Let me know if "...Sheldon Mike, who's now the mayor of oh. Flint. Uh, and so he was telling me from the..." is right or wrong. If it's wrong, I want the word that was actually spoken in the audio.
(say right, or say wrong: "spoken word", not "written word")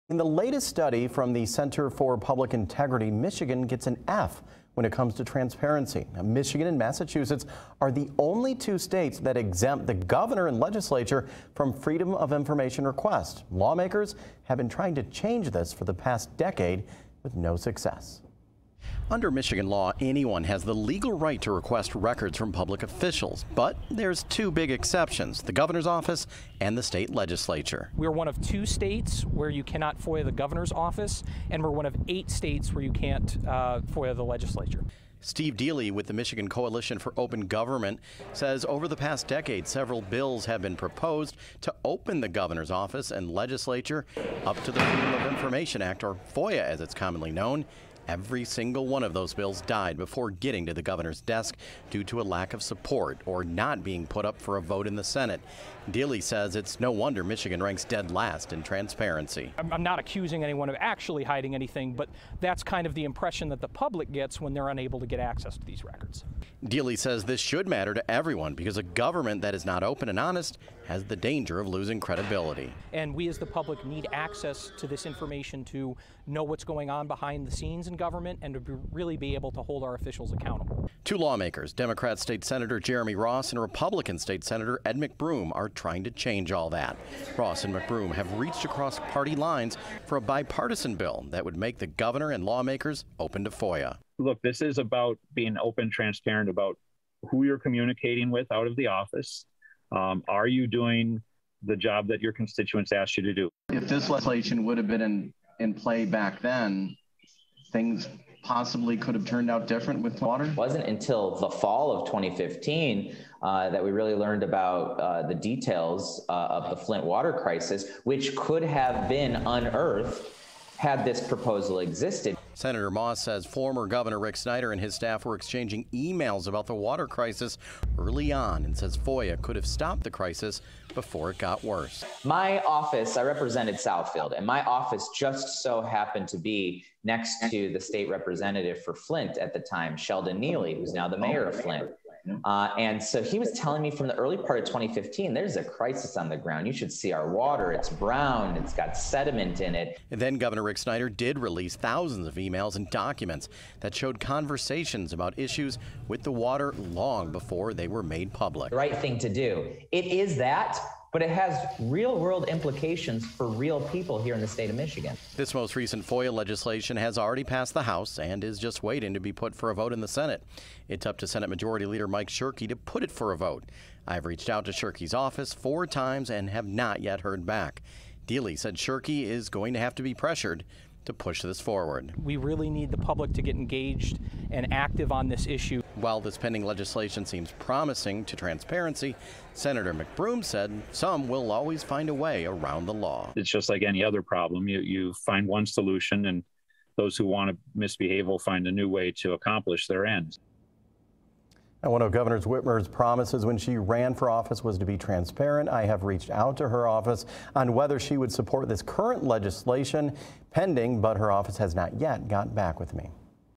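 wrong: "Neeley", not "Mike".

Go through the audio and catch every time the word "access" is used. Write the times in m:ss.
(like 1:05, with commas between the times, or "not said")
1:05, 1:14.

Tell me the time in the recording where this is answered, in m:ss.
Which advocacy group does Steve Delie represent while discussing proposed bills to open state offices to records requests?
0:36.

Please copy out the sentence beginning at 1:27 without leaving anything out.
Moss and McBroom have reached across party lines for a bipartisan bill that would make the governor and lawmakers open to FOIA.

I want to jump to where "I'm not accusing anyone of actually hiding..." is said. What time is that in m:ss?
0:59.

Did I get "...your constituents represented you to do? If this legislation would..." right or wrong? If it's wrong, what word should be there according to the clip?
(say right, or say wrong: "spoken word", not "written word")
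wrong: "asked", not "represented".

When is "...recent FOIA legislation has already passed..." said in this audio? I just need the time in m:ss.
2:45.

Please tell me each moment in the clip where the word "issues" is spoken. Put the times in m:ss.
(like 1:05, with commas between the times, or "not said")
2:35, 3:05.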